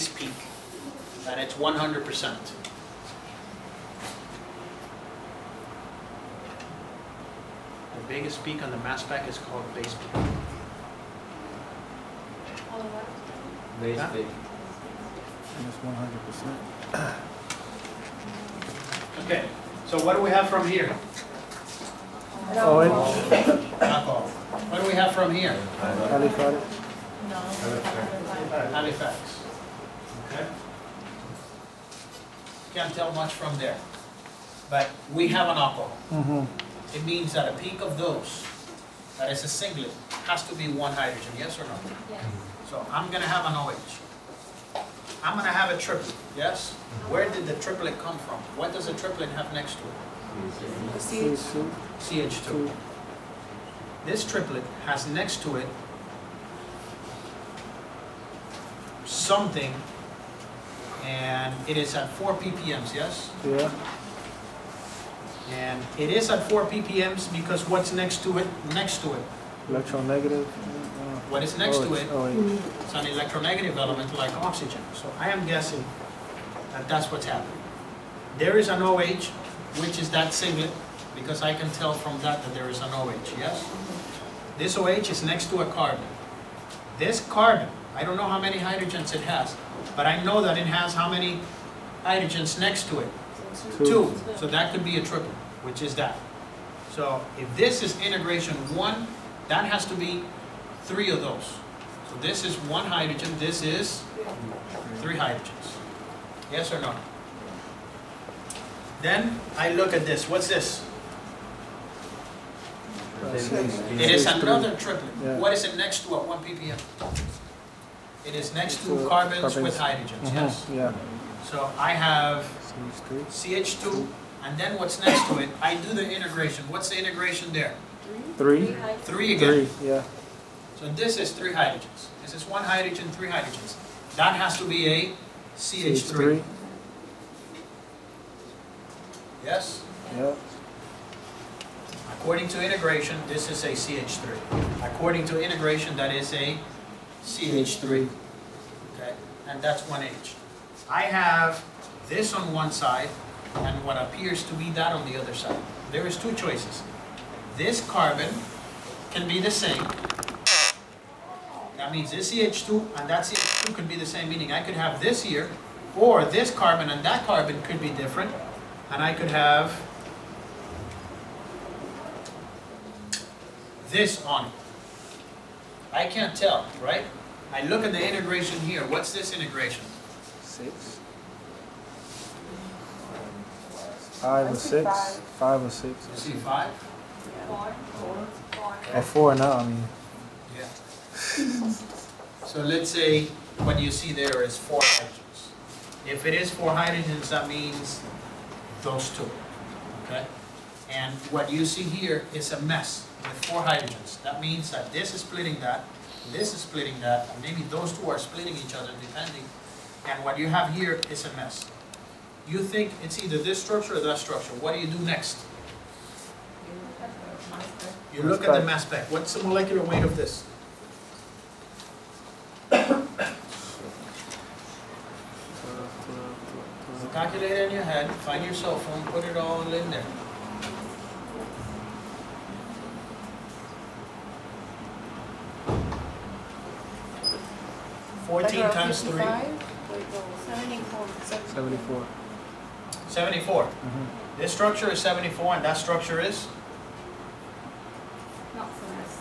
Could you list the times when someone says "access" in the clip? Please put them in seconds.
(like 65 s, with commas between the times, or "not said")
not said.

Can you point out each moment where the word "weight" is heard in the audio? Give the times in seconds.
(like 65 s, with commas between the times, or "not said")
219 s.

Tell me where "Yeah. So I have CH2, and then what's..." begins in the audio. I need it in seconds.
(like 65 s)
120 s.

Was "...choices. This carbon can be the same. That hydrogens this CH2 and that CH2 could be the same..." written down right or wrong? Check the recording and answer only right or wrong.
wrong.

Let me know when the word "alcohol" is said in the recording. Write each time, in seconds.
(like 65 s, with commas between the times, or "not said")
23 s, 35 s.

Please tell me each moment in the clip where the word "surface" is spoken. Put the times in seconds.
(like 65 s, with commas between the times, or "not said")
not said.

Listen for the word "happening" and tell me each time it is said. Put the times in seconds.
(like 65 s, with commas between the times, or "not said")
77 s.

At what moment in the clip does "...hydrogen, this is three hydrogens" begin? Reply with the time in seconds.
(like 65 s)
102 s.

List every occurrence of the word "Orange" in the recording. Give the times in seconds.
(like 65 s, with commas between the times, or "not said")
22 s.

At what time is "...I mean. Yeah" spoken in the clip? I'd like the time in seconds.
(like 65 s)
189 s.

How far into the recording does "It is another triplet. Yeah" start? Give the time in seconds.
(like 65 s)
114 s.